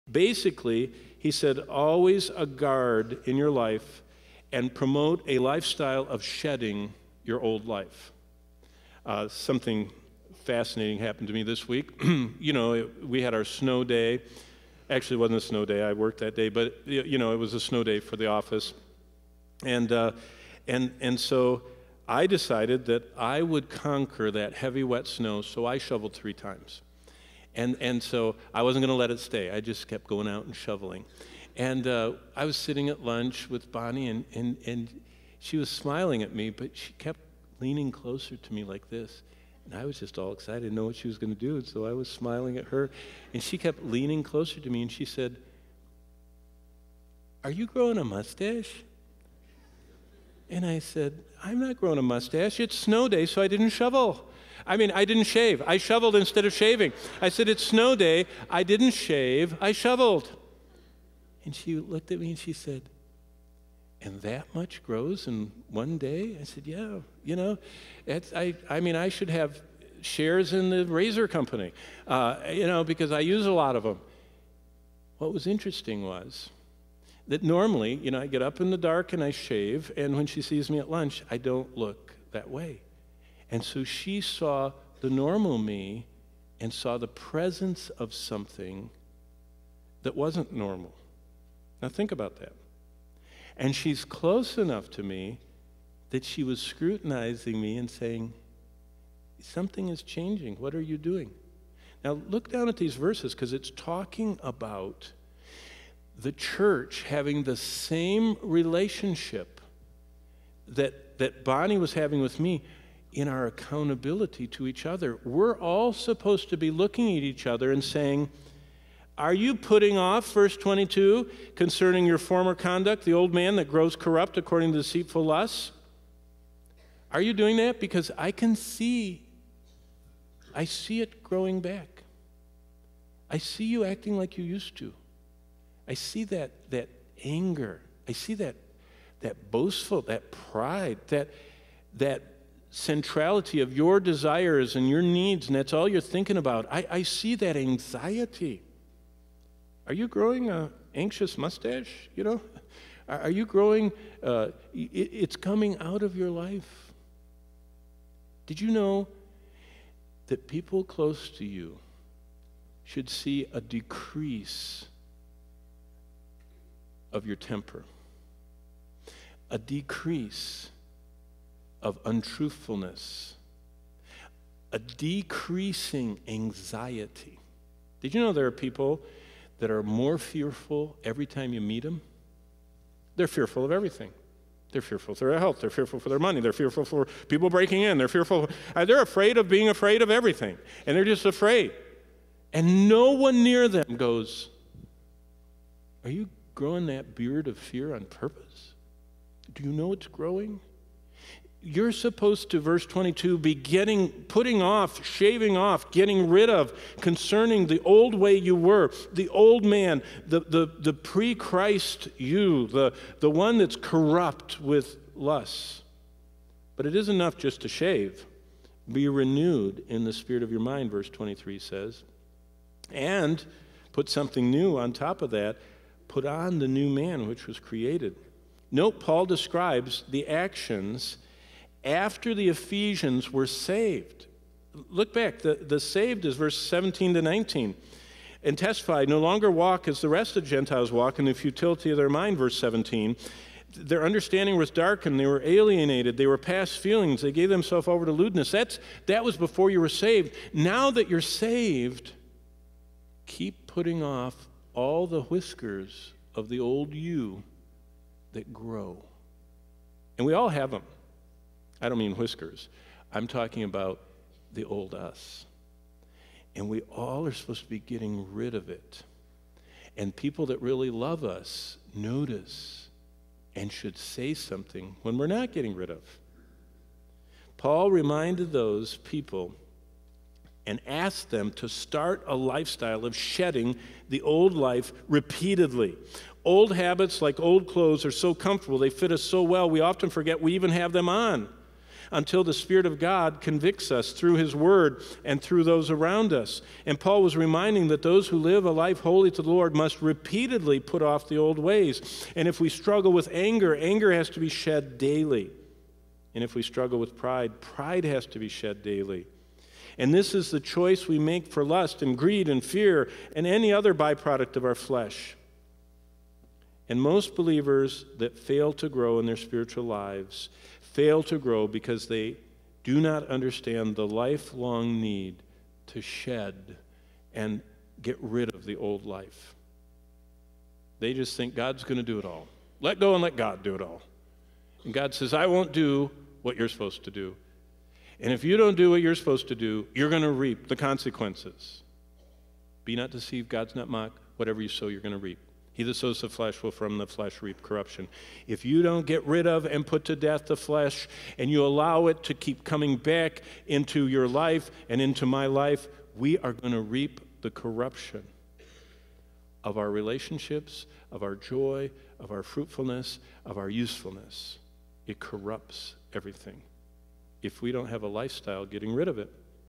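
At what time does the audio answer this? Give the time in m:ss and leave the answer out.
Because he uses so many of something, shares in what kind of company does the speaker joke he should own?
1:10.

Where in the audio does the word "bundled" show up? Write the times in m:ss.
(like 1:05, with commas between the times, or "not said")
not said.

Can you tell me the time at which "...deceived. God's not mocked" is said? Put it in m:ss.
5:43.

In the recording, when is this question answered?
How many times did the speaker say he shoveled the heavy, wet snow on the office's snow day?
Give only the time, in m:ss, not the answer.
0:26.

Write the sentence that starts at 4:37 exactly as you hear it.
Paul reminded those people and asked them to start a lifestyle of shedding the old life repeatedly.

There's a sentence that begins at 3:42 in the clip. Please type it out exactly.
And put something new on top of that put on the new man which was created.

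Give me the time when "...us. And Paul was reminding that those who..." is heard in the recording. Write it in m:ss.
4:56.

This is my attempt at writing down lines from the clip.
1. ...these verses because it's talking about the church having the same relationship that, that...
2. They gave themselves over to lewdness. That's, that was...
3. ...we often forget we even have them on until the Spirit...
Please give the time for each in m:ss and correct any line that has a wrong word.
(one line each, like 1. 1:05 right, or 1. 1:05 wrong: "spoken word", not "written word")
1. 1:42 right
2. 4:07 right
3. 4:49 right.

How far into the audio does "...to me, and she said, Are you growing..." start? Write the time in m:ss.
0:44.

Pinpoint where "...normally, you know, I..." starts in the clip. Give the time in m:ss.
1:17.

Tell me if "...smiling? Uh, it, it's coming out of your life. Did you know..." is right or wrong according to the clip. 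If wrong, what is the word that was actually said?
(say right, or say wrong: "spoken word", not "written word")
wrong: "growing", not "smiling".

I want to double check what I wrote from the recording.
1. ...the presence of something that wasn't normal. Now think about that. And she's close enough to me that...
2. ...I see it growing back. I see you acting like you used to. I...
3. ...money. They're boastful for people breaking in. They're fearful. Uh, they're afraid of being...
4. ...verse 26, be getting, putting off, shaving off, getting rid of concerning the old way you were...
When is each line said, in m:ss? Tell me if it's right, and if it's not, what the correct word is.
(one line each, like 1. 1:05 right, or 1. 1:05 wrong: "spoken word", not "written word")
1. 1:26 right
2. 2:10 right
3. 3:06 wrong: "fearful", not "boastful"
4. 3:22 wrong: "22", not "26".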